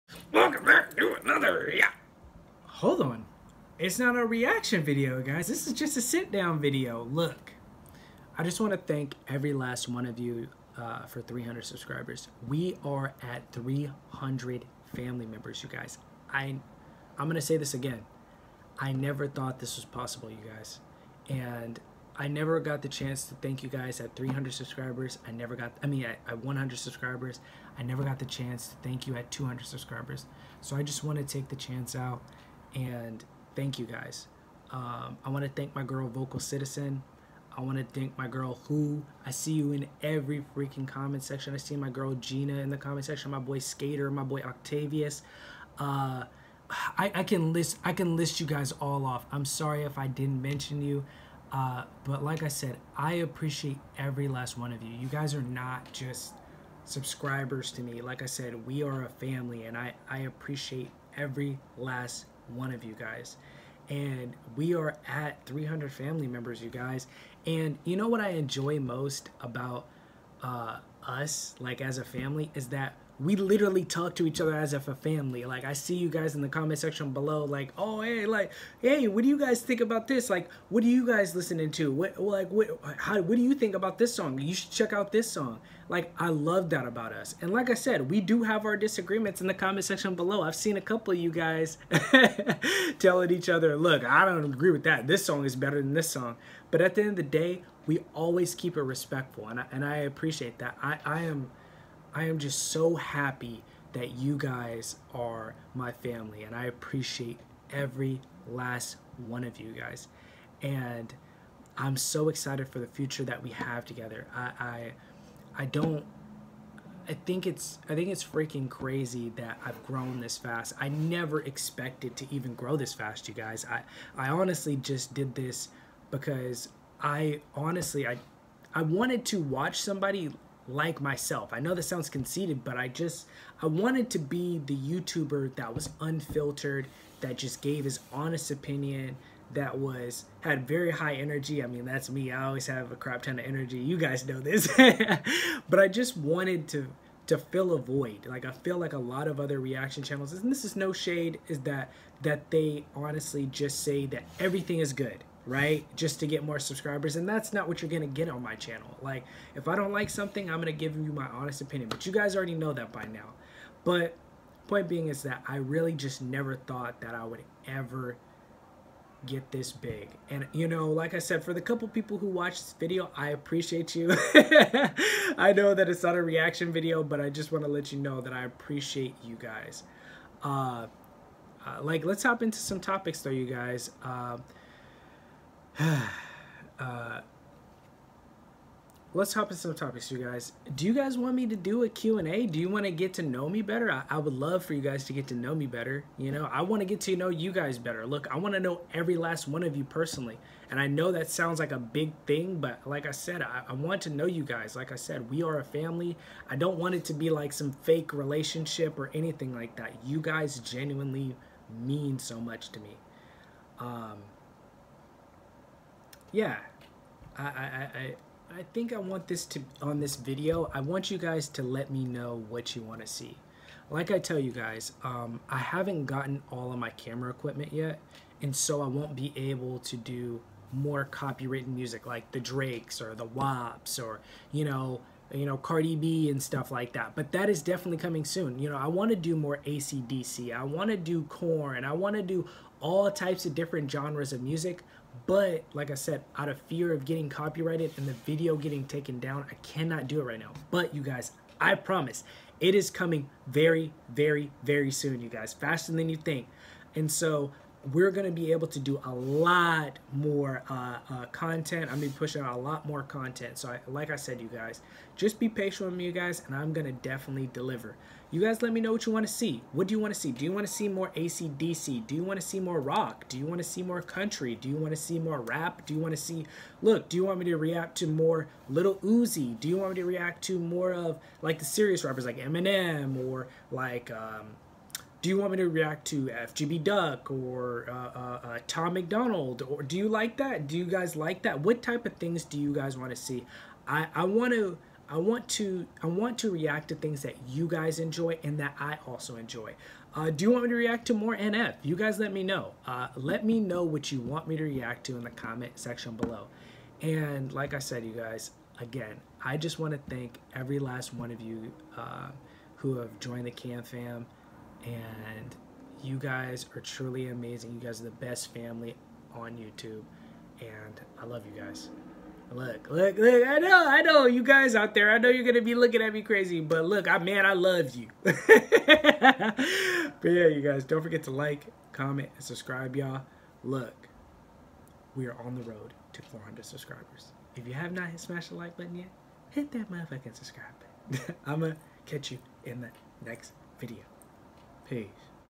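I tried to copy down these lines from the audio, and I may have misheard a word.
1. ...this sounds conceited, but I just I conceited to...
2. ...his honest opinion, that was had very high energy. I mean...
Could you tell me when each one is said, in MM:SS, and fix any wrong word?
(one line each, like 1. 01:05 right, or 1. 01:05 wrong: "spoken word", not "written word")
1. 02:11 wrong: "wanted", not "conceited"
2. 02:17 right.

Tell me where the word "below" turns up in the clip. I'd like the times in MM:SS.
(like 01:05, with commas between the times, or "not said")
01:17, 01:30, 05:06.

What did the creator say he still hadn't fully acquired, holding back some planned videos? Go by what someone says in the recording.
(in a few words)
camera equipment.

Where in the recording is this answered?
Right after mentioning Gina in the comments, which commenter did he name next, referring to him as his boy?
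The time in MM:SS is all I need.
00:43.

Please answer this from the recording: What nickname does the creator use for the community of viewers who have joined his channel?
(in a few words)
Cam Fam.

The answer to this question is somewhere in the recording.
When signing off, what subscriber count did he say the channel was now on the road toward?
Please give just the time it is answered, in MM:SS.
05:36.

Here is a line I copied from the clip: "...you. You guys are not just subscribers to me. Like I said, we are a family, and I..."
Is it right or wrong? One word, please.
right.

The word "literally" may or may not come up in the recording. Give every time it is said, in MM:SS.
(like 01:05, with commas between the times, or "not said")
01:13.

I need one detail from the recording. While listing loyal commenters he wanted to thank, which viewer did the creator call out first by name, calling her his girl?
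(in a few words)
Vocal Citizen.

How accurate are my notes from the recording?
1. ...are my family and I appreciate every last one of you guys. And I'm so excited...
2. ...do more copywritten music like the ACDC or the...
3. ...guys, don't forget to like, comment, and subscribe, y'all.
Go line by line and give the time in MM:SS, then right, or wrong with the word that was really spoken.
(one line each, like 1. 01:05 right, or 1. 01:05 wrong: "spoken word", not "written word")
1. 01:45 right
2. 03:49 wrong: "Drakes", not "ACDC"
3. 05:30 right.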